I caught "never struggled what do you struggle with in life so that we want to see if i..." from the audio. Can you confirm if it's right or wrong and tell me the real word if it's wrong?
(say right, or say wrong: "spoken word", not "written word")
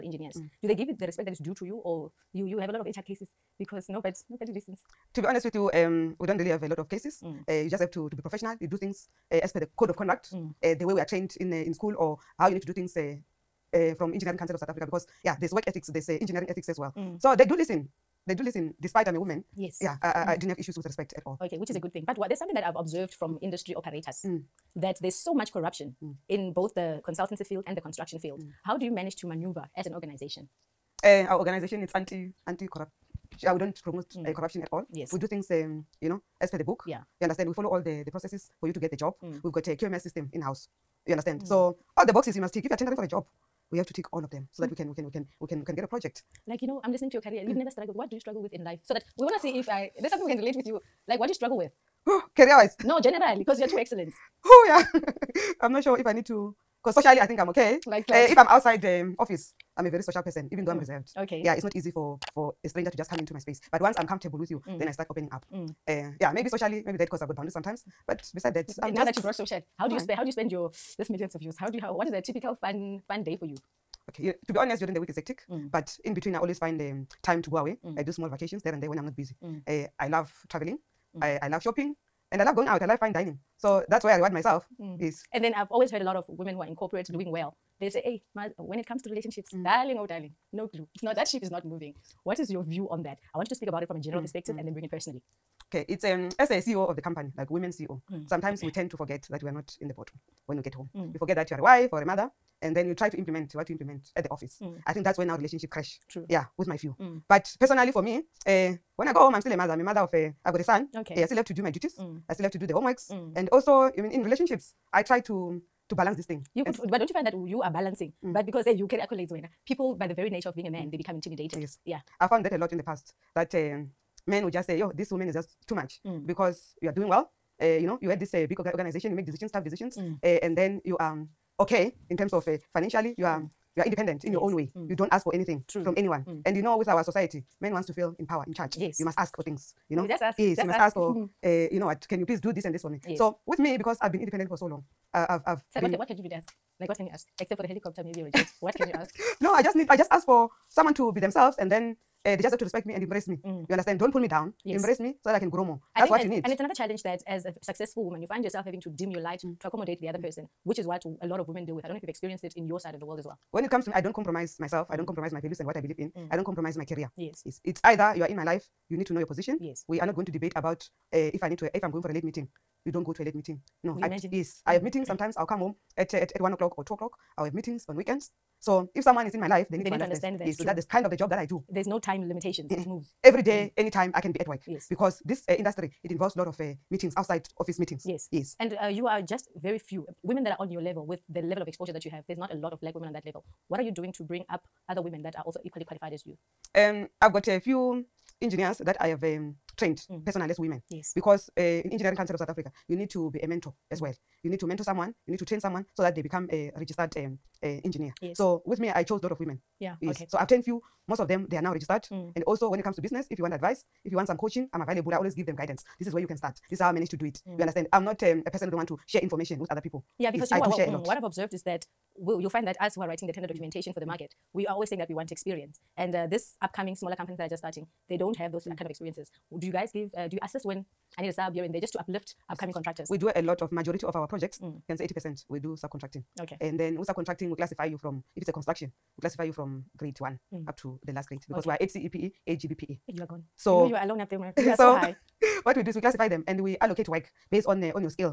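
right.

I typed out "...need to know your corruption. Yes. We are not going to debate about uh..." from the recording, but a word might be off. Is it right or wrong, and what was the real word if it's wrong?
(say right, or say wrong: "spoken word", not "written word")
wrong: "position", not "corruption".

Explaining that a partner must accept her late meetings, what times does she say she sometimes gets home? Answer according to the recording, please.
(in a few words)
1 or 2 o'clock.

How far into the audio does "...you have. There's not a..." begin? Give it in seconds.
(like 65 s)
192 s.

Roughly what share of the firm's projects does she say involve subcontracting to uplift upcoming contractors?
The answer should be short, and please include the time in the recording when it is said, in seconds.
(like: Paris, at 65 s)
80 percent, at 235 s.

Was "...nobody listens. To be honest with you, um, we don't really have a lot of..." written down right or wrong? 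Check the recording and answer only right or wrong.
right.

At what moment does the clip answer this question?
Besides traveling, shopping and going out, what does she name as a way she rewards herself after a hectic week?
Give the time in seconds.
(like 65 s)
82 s.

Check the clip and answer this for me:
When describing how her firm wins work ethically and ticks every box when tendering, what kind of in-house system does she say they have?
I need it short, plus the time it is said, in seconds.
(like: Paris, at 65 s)
QMS, at 39 s.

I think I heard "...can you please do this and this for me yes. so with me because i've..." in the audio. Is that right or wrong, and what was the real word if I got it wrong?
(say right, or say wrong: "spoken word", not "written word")
right.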